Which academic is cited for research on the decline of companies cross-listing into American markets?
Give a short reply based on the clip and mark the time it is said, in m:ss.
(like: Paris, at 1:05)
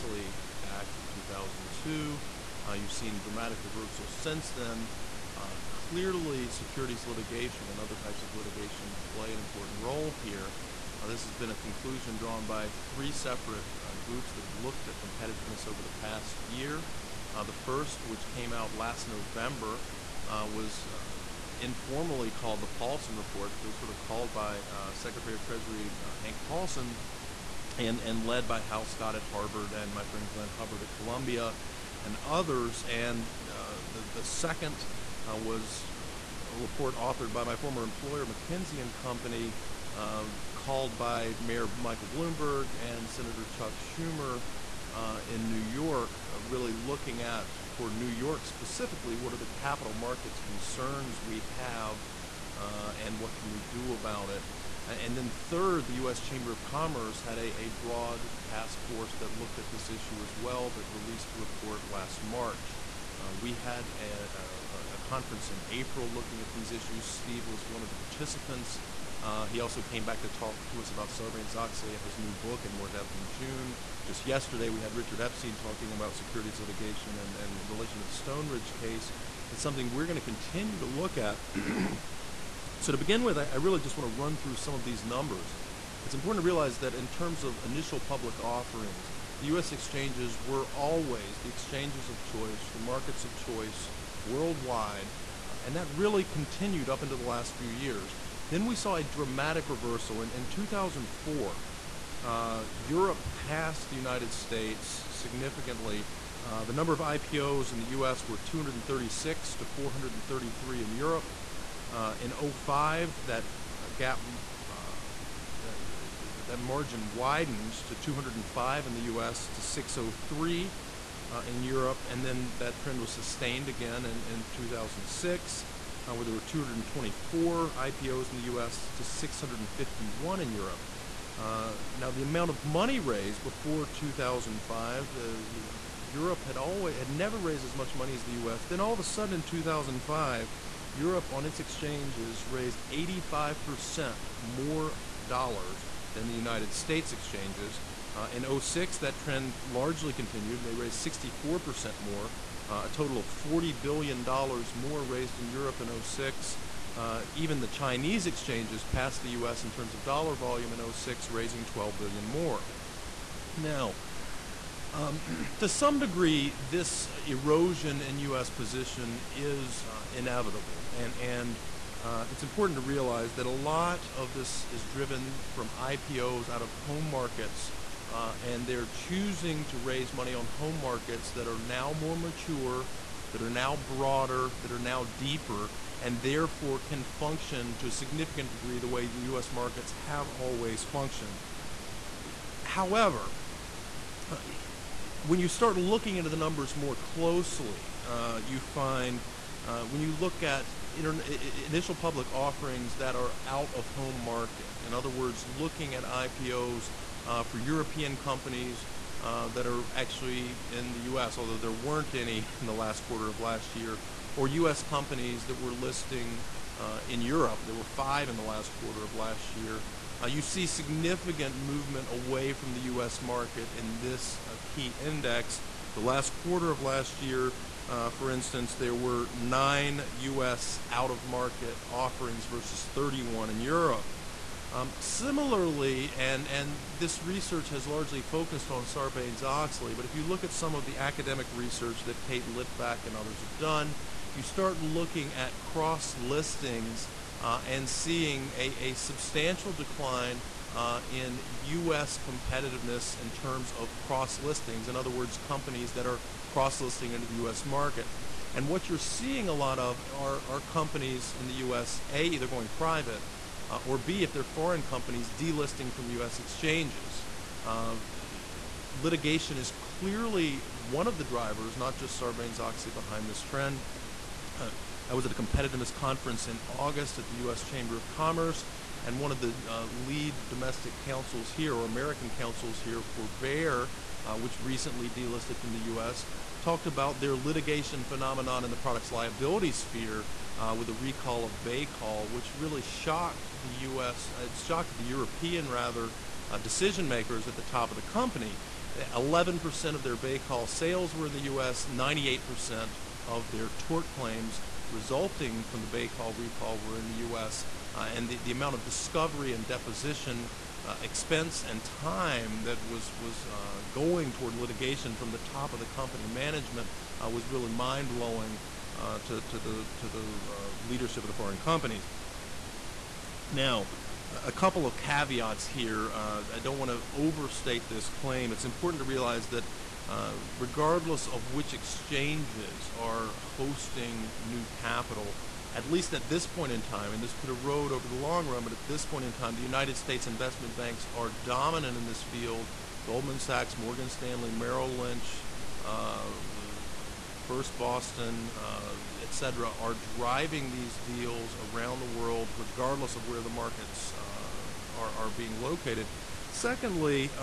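Kate Litvak, at 4:02.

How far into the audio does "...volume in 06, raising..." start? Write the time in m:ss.
2:40.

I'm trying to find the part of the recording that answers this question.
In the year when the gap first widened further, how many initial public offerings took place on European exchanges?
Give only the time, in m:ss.
1:59.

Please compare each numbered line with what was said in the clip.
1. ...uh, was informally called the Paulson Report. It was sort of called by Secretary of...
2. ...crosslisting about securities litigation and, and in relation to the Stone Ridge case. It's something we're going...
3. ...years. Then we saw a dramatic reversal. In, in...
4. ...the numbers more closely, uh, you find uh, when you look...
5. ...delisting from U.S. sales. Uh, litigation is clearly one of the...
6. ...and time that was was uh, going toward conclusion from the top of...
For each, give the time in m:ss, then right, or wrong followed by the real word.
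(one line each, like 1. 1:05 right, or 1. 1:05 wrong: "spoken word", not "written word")
1. 0:20 right
2. 1:15 wrong: "talking", not "crosslisting"
3. 1:37 right
4. 3:16 right
5. 4:25 wrong: "exchanges", not "sales"
6. 5:11 wrong: "litigation", not "conclusion".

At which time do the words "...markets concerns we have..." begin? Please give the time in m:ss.
0:49.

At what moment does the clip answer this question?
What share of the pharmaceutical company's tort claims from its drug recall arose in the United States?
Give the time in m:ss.
5:01.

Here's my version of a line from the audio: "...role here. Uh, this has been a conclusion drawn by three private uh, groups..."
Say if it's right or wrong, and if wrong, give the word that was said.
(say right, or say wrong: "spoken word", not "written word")
wrong: "separate", not "private".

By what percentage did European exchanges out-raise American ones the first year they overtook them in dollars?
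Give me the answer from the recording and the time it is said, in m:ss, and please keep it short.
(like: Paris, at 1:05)
85%, at 2:22.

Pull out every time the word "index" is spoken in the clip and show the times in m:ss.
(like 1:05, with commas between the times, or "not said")
3:44.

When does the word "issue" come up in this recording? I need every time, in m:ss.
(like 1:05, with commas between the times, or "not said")
0:59, 1:06.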